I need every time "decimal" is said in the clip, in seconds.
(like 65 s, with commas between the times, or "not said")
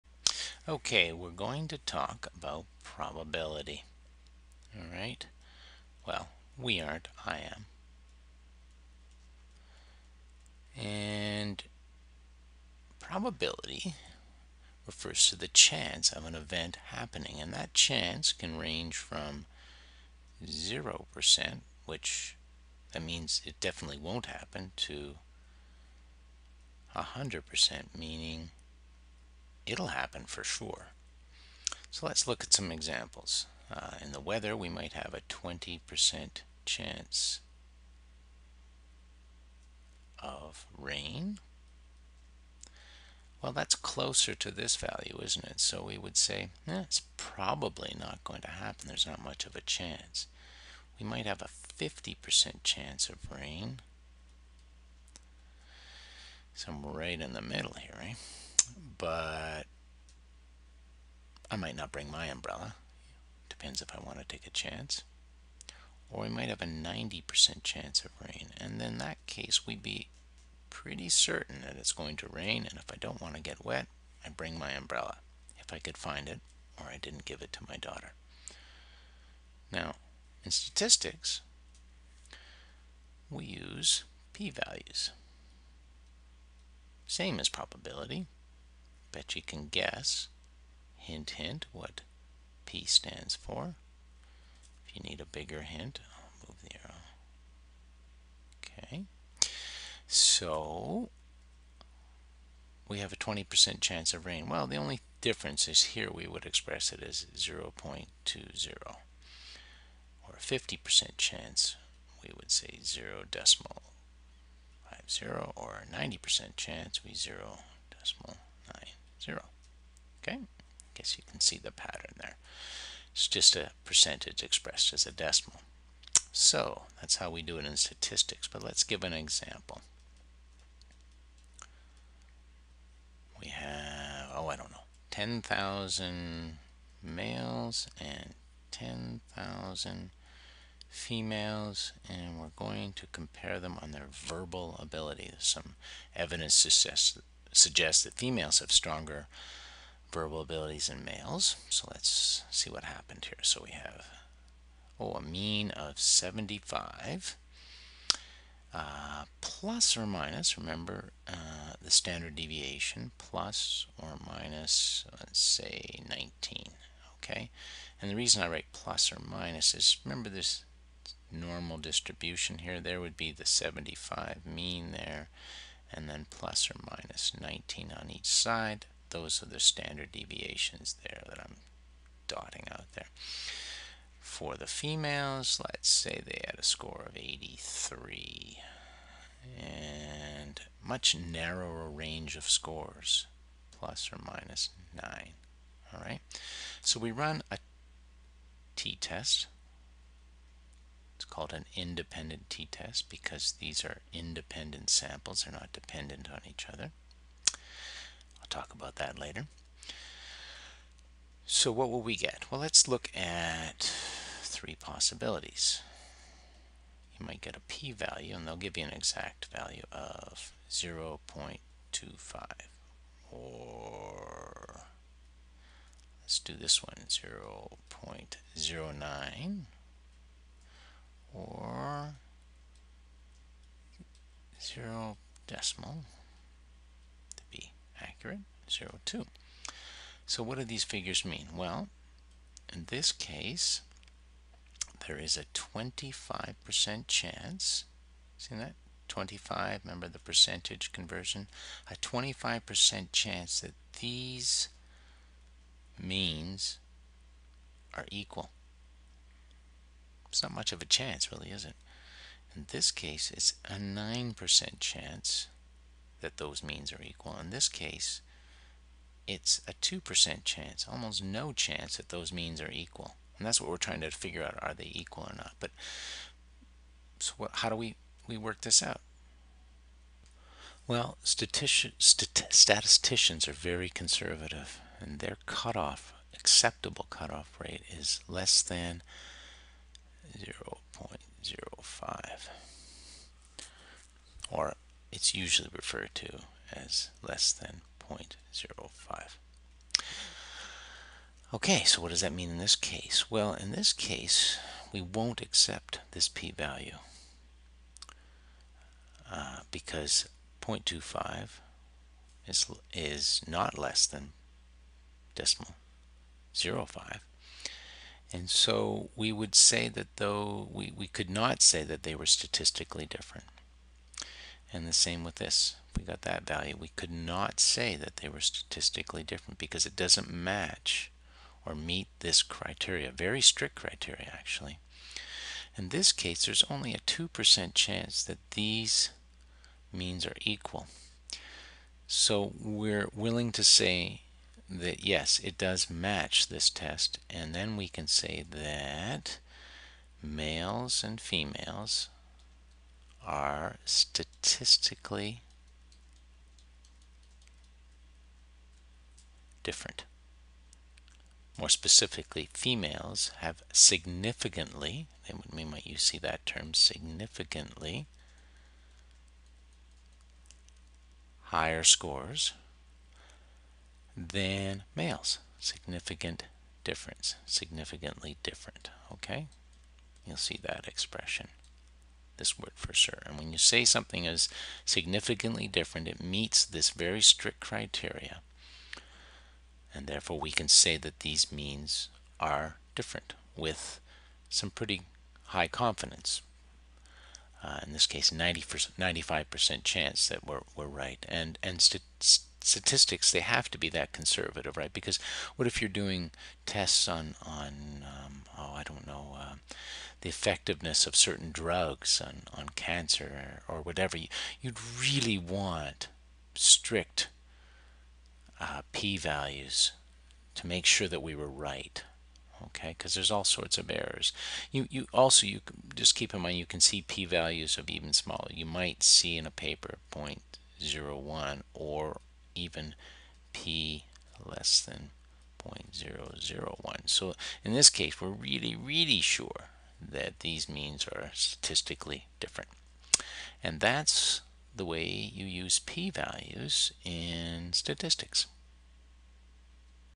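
113 s, 117 s, 125 s, 235 s, 315 s.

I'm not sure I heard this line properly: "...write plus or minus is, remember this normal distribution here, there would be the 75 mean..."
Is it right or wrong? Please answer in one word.
right.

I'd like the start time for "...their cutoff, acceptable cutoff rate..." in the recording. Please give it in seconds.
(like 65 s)
285 s.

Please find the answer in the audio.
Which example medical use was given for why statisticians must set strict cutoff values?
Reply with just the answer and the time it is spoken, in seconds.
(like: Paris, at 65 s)
cancer, at 412 s.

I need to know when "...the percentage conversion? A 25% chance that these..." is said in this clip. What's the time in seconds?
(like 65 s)
250 s.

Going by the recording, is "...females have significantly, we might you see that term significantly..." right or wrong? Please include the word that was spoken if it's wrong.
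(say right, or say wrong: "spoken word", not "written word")
right.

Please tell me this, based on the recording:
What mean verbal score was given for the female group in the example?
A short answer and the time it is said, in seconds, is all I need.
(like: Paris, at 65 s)
83, at 186 s.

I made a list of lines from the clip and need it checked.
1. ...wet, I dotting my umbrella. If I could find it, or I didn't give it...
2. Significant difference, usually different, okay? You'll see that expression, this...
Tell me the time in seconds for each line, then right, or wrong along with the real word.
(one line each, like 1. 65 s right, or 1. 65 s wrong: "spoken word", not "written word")
1. 73 s wrong: "bring", not "dotting"
2. 375 s wrong: "significantly", not "usually".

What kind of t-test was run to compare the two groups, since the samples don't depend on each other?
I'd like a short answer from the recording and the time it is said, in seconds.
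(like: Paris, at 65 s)
independent t-test, at 201 s.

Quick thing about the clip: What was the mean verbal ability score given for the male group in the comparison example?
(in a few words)
75.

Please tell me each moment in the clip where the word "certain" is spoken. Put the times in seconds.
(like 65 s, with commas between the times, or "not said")
71 s, 411 s.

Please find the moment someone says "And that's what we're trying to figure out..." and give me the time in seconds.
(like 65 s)
273 s.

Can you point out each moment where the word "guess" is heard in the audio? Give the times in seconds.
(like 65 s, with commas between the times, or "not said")
89 s, 120 s.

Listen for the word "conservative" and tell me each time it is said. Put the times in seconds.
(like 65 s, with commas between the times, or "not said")
283 s, 404 s.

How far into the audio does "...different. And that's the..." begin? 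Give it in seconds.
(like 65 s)
442 s.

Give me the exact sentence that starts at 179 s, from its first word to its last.
Those are the standard deviations there that I'm dotting out there.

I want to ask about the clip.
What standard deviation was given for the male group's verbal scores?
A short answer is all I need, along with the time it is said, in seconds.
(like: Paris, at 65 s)
19, at 163 s.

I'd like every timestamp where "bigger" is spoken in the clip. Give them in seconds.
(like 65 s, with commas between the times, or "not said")
95 s.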